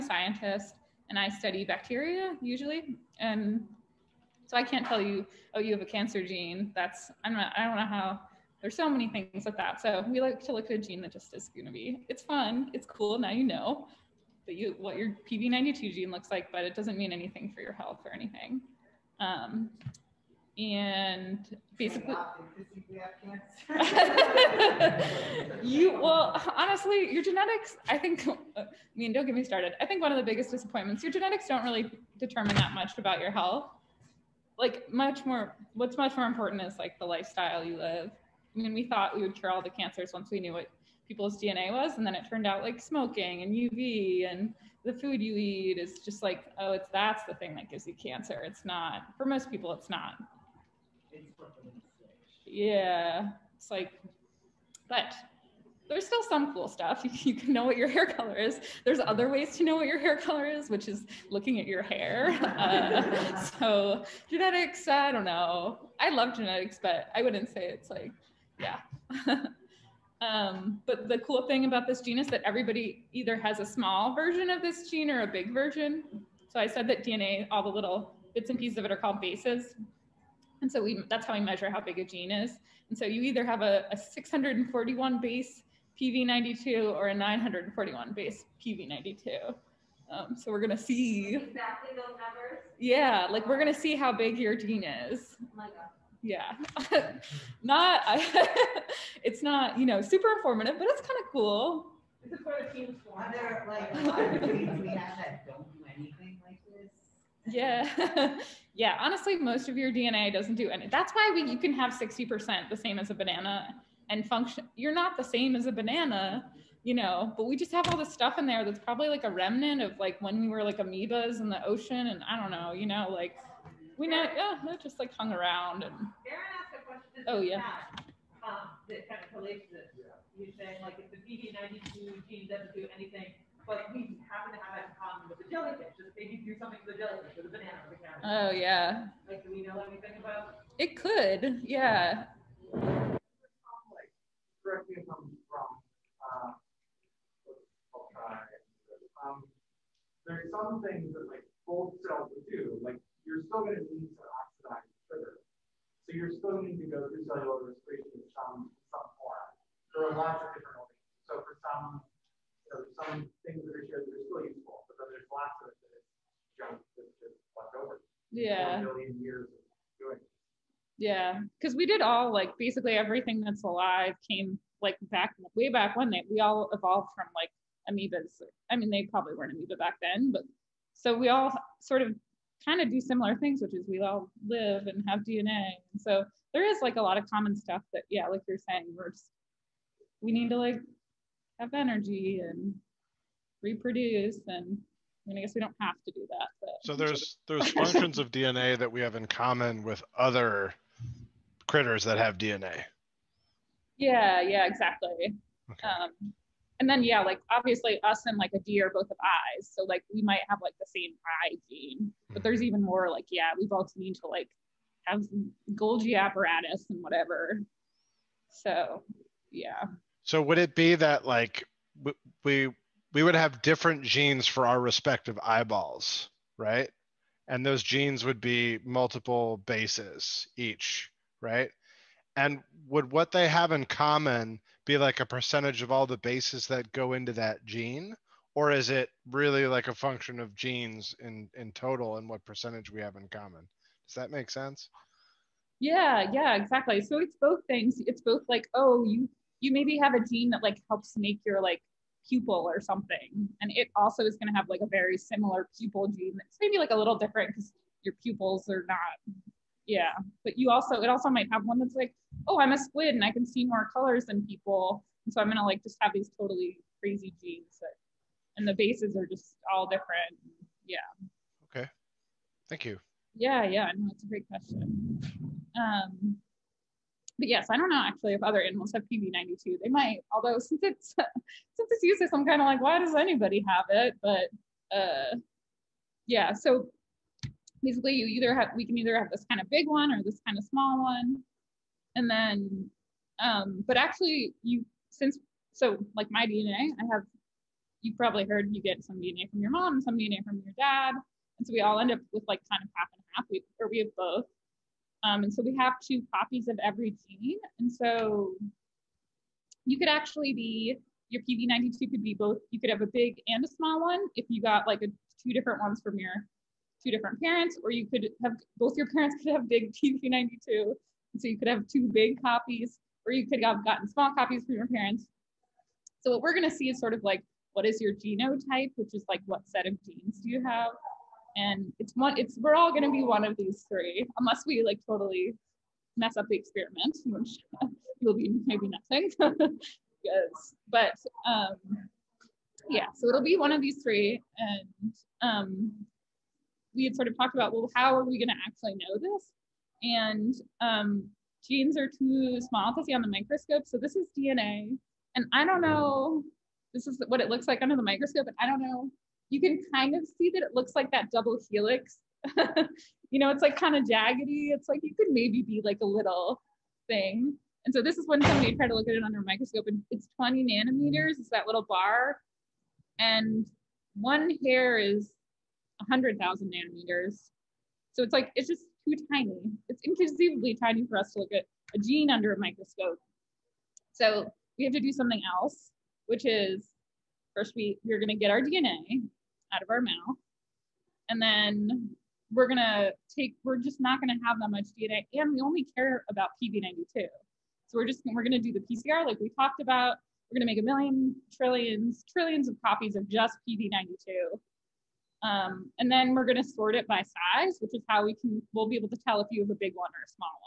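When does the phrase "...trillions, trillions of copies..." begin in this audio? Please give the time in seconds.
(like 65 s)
401 s.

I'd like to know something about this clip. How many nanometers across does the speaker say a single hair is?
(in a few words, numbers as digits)
100,000.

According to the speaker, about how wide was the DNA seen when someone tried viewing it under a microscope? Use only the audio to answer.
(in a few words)
20 nanometers.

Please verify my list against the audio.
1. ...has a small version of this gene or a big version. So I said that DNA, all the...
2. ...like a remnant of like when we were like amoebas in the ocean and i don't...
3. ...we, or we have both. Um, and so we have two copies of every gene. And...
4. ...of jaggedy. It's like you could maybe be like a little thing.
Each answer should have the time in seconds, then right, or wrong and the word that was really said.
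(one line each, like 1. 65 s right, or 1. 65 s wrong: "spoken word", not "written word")
1. 73 s right
2. 119 s right
3. 303 s right
4. 363 s right.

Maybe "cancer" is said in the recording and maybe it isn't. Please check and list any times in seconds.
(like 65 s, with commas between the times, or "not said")
5 s, 39 s, 47 s.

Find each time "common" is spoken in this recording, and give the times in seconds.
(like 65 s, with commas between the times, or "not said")
134 s, 187 s, 199 s, 233 s, 243 s.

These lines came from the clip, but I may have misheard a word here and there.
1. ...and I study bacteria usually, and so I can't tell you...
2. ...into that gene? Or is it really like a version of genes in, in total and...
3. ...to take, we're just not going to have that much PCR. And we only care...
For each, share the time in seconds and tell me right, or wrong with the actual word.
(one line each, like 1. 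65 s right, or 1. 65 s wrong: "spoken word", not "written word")
1. 1 s right
2. 237 s wrong: "function", not "version"
3. 392 s wrong: "DNA", not "PCR".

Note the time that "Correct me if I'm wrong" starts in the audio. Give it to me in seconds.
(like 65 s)
144 s.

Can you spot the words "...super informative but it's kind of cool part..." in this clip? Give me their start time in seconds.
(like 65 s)
100 s.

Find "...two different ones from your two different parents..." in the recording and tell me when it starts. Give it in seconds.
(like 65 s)
315 s.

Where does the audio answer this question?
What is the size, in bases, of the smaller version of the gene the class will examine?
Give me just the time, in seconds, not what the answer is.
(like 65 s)
83 s.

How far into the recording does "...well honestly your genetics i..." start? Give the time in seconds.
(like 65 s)
25 s.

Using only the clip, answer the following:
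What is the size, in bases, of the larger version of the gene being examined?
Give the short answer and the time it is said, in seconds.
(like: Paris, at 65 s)
941, at 87 s.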